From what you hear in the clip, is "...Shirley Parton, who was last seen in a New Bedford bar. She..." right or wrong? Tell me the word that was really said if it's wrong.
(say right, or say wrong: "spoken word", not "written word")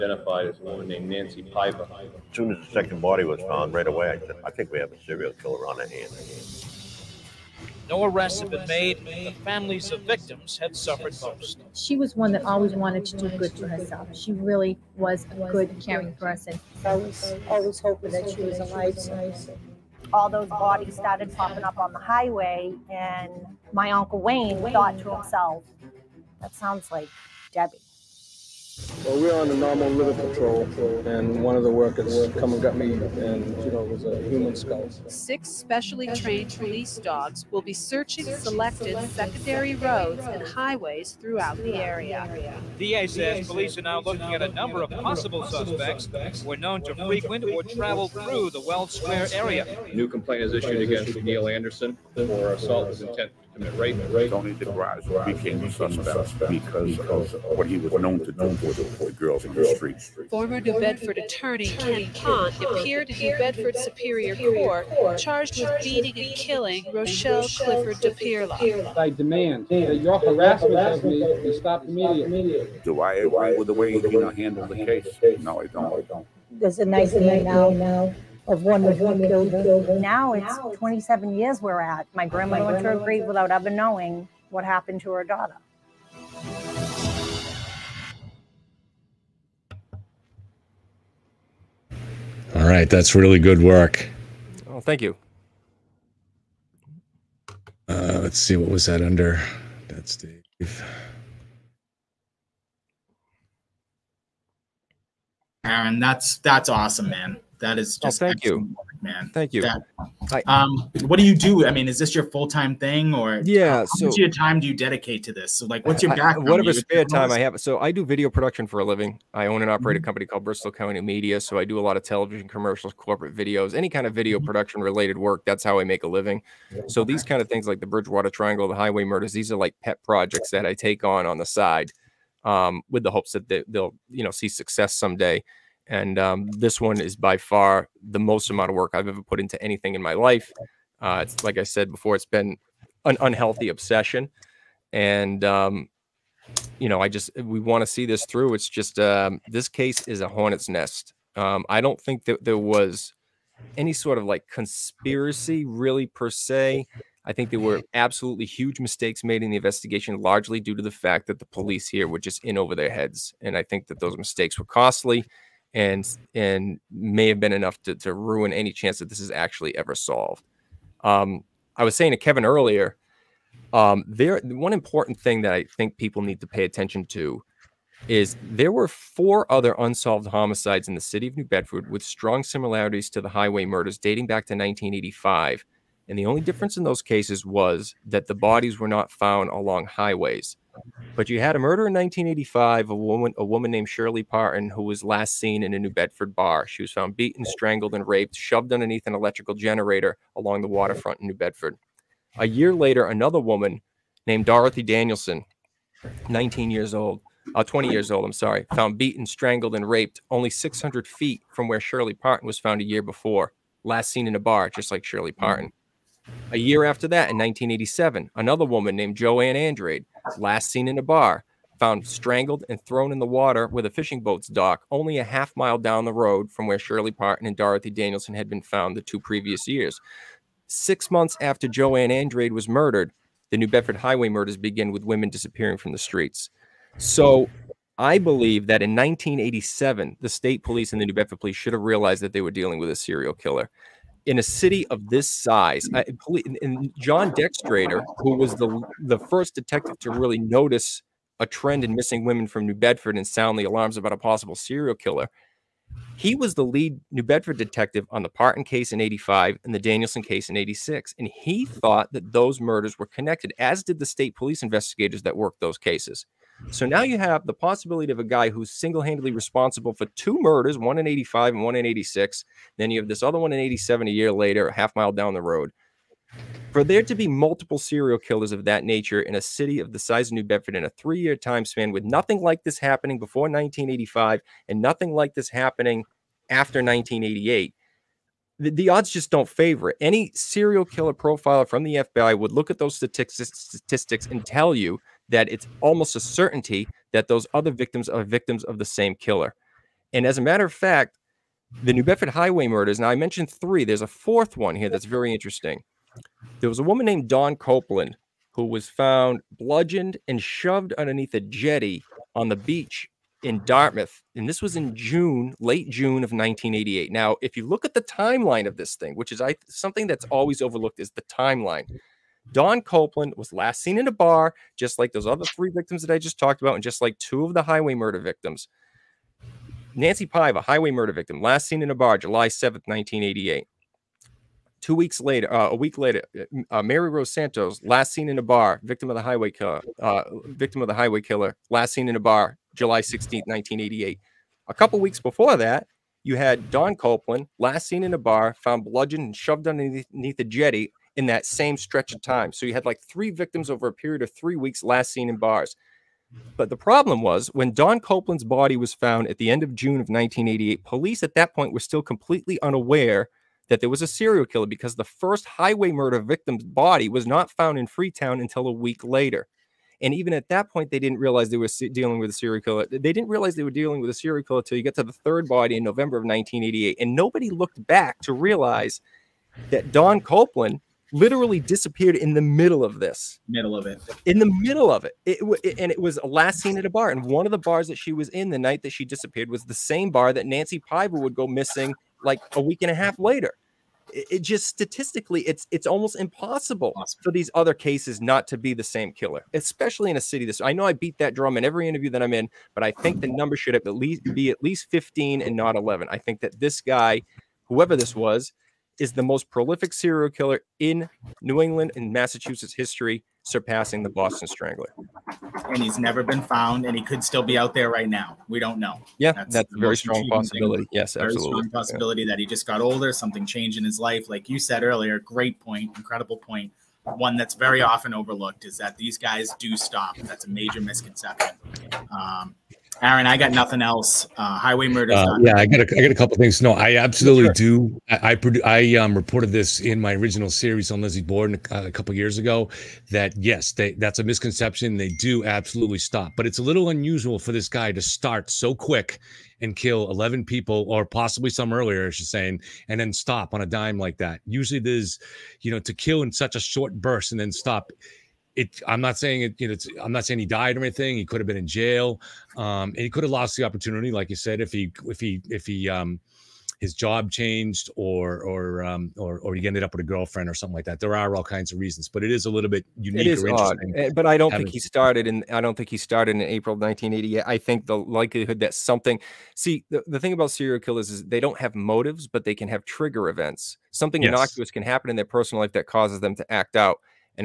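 right.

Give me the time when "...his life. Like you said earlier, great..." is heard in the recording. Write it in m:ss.
7:03.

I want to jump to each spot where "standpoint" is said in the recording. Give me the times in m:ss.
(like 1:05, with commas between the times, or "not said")
not said.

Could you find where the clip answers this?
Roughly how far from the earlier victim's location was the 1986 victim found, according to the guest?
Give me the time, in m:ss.
3:30.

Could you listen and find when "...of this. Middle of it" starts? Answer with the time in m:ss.
6:22.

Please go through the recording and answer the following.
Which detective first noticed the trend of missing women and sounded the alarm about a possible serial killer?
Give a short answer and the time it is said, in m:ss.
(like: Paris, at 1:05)
John Dextradeur, at 4:06.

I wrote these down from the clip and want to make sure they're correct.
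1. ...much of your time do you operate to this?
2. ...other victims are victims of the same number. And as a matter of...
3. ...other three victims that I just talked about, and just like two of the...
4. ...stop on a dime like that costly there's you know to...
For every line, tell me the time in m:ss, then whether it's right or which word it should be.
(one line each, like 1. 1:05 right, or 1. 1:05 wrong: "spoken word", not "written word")
1. 1:54 wrong: "dedicate", not "operate"
2. 4:57 wrong: "killer", not "number"
3. 5:25 right
4. 7:33 wrong: "usually", not "costly".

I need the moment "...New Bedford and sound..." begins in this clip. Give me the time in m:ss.
4:12.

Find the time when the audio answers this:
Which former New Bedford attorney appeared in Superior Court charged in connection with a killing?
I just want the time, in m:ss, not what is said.
1:01.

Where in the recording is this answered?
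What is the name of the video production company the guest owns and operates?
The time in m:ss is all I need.
2:00.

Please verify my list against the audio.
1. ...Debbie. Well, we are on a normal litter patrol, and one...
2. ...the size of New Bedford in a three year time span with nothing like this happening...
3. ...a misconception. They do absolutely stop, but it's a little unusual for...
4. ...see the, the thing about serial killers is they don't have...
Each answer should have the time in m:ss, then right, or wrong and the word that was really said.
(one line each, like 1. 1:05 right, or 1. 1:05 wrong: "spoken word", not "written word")
1. 0:27 right
2. 4:39 right
3. 7:24 right
4. 7:59 right.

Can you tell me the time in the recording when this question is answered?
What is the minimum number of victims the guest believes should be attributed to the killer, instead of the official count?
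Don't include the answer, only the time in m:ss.
6:44.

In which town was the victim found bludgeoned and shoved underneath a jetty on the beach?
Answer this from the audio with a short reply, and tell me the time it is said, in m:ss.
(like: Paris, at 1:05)
Dartmouth, at 5:13.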